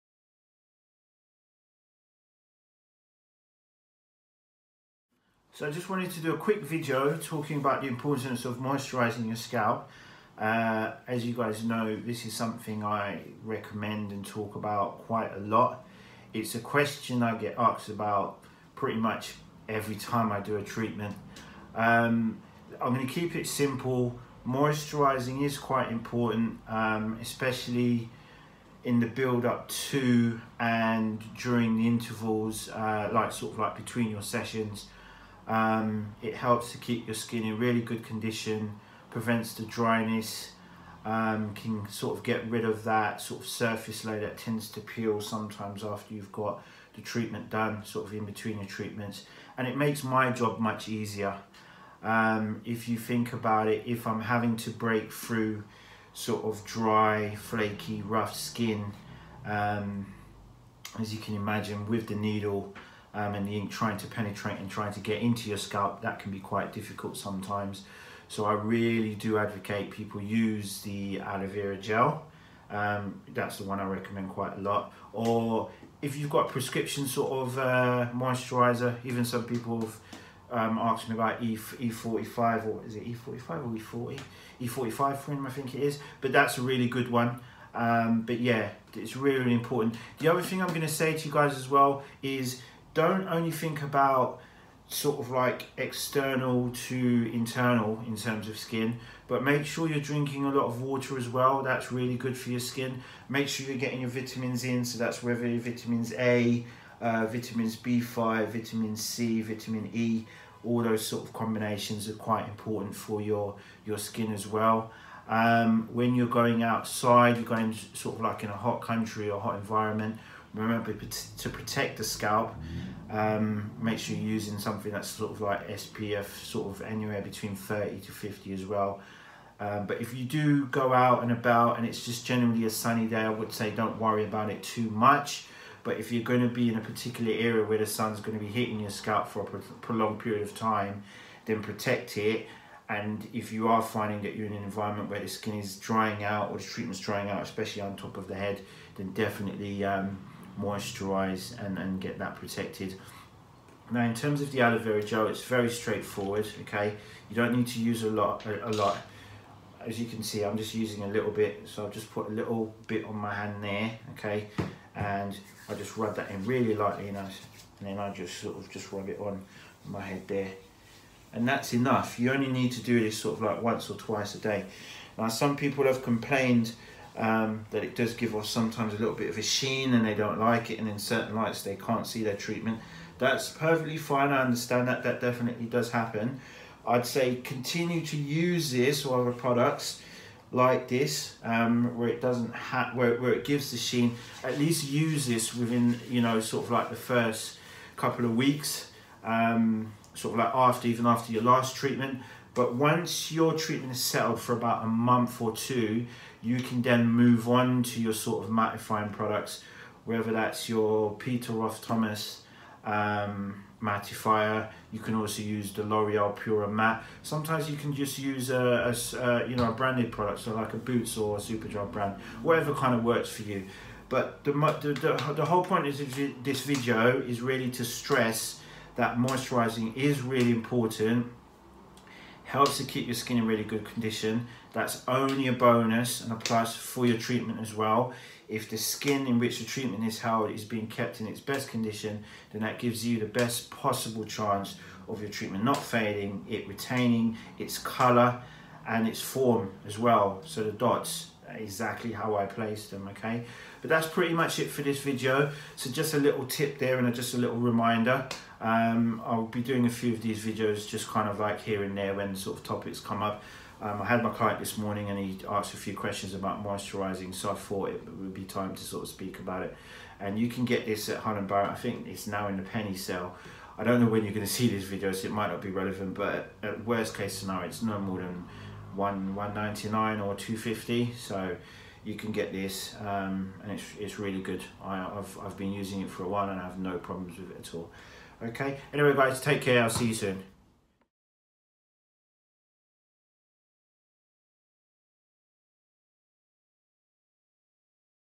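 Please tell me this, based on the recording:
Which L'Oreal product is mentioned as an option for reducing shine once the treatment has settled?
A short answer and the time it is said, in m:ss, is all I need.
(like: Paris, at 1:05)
Pura Matte, at 3:36.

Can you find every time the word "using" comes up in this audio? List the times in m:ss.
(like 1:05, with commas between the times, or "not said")
2:04, 2:40, 4:45.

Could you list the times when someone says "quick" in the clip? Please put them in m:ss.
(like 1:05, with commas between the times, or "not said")
0:06.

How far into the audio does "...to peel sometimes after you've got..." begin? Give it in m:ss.
0:44.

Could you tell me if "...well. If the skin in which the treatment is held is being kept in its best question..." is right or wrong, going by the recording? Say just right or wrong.
wrong.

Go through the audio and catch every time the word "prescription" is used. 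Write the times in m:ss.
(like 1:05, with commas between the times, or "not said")
1:16.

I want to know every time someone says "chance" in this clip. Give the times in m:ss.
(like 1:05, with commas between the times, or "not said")
4:04.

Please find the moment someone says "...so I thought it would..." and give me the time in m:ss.
4:27.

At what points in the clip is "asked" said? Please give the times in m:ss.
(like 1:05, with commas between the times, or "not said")
0:17, 1:20, 4:25.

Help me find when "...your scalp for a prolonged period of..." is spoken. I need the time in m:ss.
2:18.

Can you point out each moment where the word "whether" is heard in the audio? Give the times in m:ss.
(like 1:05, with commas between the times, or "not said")
1:45, 3:30.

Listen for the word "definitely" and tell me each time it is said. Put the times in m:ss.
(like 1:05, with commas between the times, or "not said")
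2:29, 3:05.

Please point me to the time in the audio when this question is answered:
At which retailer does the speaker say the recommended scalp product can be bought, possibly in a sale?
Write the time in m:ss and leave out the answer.
4:31.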